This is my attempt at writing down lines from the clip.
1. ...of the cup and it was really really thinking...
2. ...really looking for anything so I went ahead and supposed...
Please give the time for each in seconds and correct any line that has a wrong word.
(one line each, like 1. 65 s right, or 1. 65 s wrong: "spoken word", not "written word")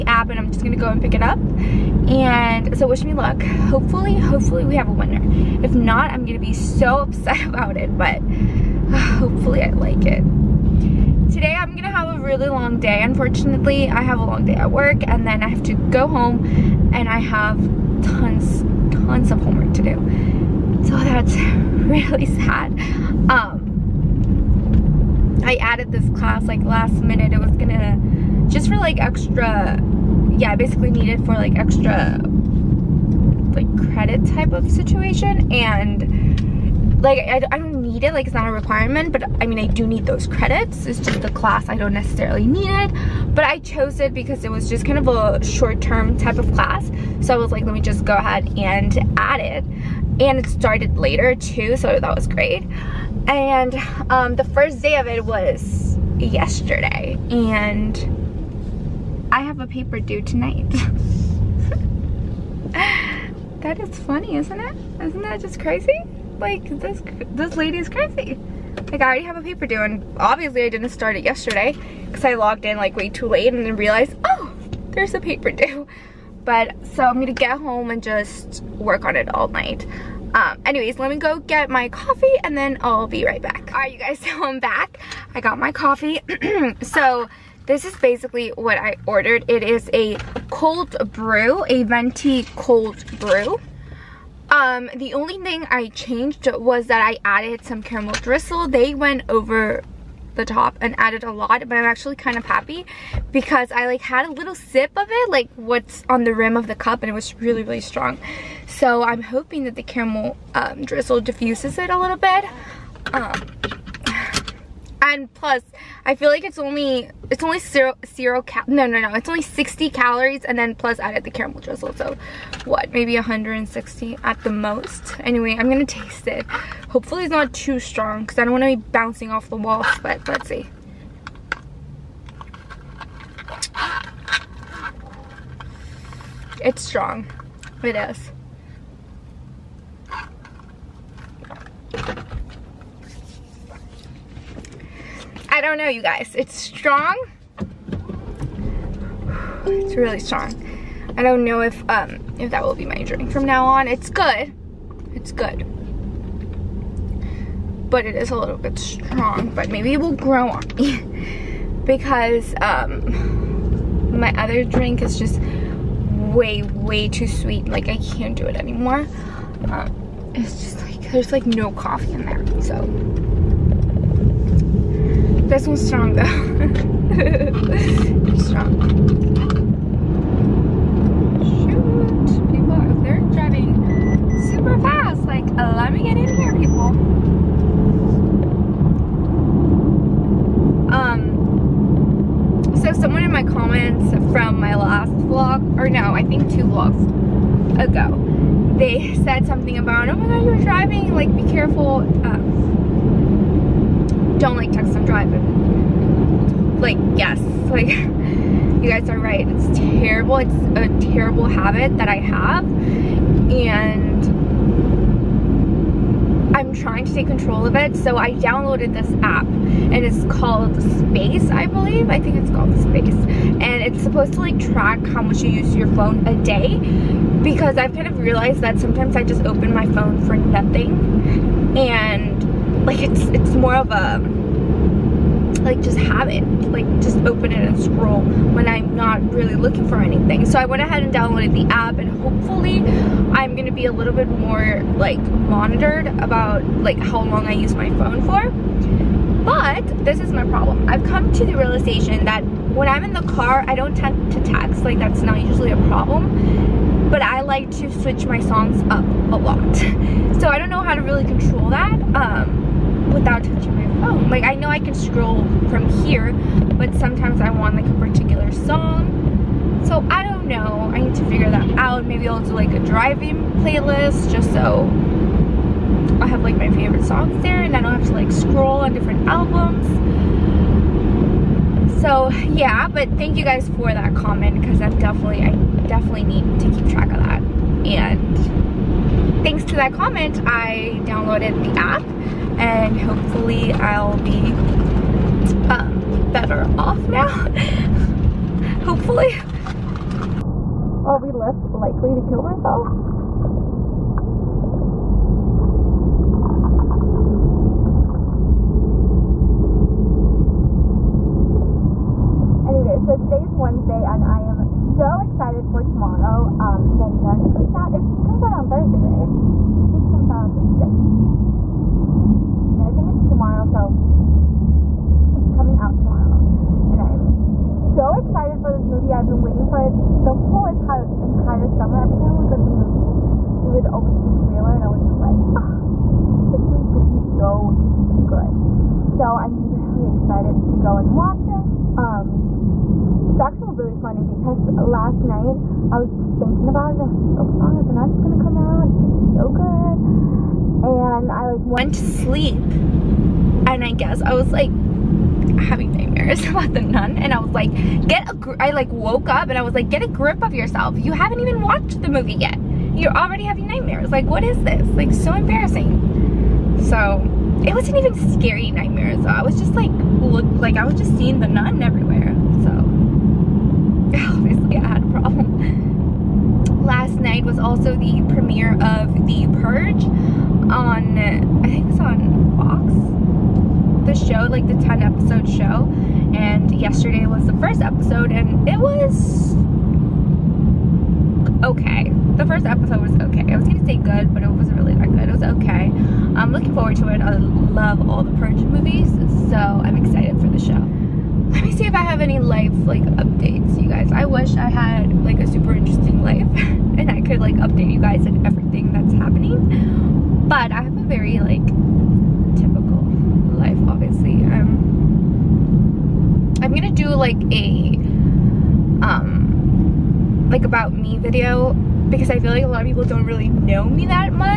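1. 106 s wrong: "strong", not "thinking"
2. 239 s wrong: "downloaded", not "supposed".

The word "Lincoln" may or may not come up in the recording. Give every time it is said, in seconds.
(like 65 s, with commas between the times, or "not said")
not said.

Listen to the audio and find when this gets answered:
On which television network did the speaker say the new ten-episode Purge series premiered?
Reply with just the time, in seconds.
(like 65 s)
382 s.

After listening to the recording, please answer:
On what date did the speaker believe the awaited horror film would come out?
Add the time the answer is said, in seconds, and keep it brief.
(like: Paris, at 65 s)
The 6th, at 320 s.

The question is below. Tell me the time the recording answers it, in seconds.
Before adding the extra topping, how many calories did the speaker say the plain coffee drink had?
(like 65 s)
119 s.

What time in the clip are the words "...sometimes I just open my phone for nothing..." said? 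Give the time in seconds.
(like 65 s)
228 s.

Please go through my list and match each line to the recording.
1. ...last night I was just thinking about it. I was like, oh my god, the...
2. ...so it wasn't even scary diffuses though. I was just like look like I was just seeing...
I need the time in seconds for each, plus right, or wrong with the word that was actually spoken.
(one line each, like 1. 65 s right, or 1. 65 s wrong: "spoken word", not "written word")
1. 344 s right
2. 366 s wrong: "nightmares", not "diffuses".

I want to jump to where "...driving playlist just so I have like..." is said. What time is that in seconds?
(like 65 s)
272 s.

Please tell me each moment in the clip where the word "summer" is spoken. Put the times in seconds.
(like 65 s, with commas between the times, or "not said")
331 s.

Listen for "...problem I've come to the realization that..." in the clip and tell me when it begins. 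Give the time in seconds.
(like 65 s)
250 s.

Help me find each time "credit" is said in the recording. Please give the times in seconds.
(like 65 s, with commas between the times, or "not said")
33 s, 40 s.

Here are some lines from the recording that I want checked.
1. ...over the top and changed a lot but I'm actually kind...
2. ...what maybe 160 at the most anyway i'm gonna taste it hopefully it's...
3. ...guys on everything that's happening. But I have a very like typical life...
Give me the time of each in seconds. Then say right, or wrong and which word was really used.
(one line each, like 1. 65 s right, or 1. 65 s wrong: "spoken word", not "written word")
1. 99 s wrong: "added", not "changed"
2. 122 s right
3. 407 s right.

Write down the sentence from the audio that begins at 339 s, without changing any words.
So I'm really excited to go and watch it.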